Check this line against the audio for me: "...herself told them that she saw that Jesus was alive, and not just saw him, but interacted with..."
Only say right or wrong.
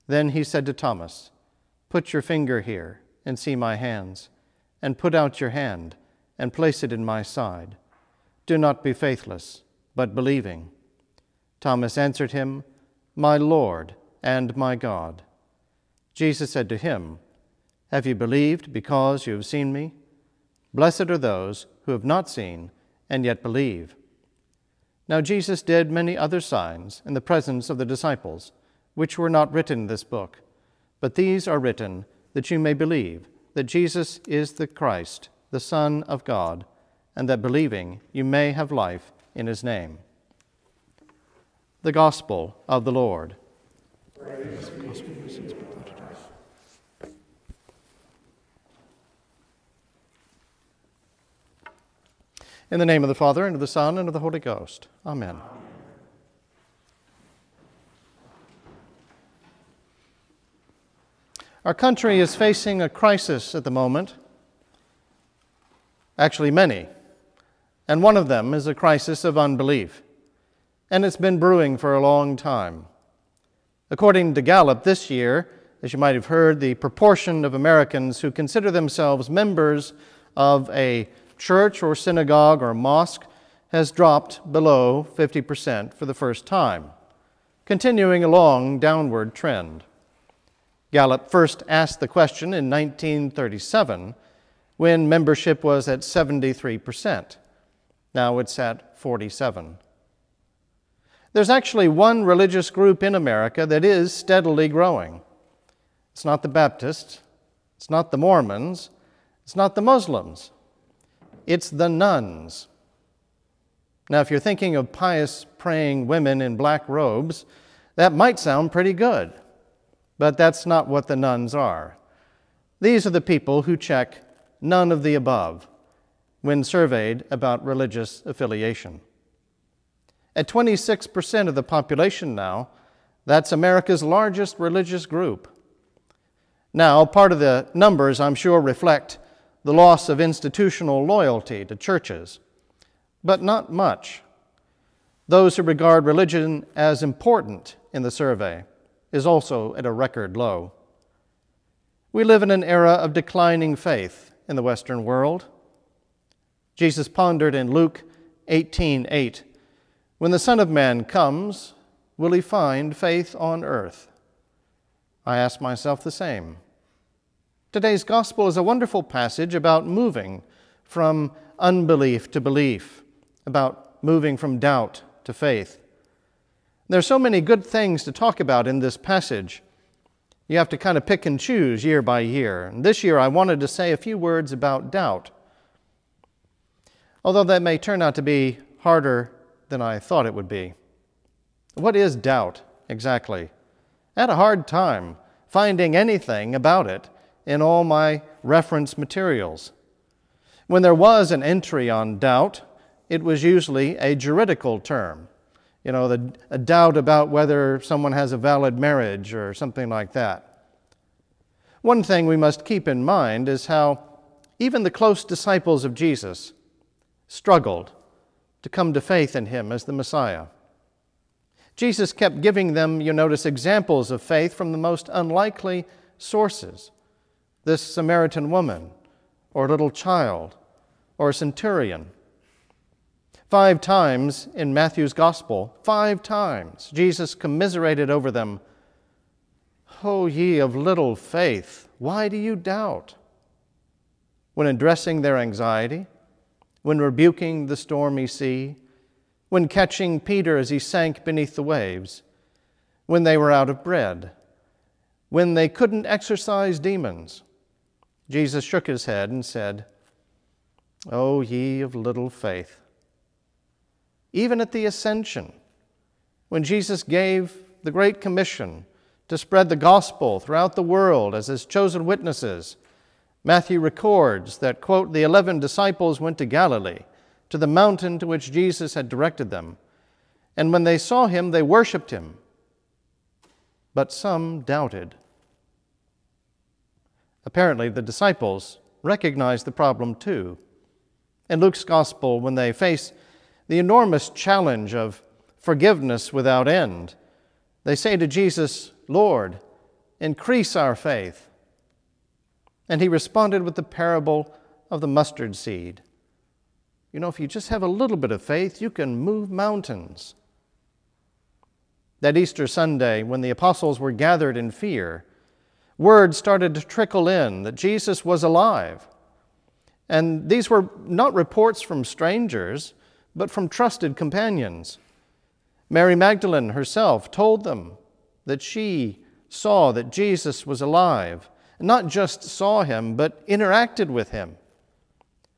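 right.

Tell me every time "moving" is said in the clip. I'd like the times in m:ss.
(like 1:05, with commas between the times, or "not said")
2:49, 2:54.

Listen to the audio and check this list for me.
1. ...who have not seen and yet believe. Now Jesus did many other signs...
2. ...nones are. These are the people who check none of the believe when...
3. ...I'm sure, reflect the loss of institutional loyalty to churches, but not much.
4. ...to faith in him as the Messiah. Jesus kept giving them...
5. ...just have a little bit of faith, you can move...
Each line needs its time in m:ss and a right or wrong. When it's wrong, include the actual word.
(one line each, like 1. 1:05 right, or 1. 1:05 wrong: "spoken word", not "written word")
1. 0:21 right
2. 2:01 wrong: "above", not "believe"
3. 2:18 right
4. 3:38 right
5. 5:07 right.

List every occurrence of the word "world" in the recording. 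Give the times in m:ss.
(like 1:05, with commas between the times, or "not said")
2:35, 4:30.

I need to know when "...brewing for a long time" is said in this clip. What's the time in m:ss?
1:11.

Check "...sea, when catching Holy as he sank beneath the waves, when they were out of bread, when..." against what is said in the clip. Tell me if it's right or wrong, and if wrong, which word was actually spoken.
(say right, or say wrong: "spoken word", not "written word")
wrong: "Peter", not "Holy".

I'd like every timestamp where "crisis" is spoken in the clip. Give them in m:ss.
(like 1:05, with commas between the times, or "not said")
1:02, 1:08.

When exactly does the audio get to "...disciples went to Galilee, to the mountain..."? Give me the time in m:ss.
4:35.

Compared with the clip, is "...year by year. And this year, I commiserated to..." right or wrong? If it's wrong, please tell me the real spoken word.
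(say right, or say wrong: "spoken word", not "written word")
wrong: "wanted", not "commiserated".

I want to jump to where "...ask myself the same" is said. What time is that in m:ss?
2:45.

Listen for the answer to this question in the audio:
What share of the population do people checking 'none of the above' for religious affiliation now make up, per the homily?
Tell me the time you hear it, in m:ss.
2:10.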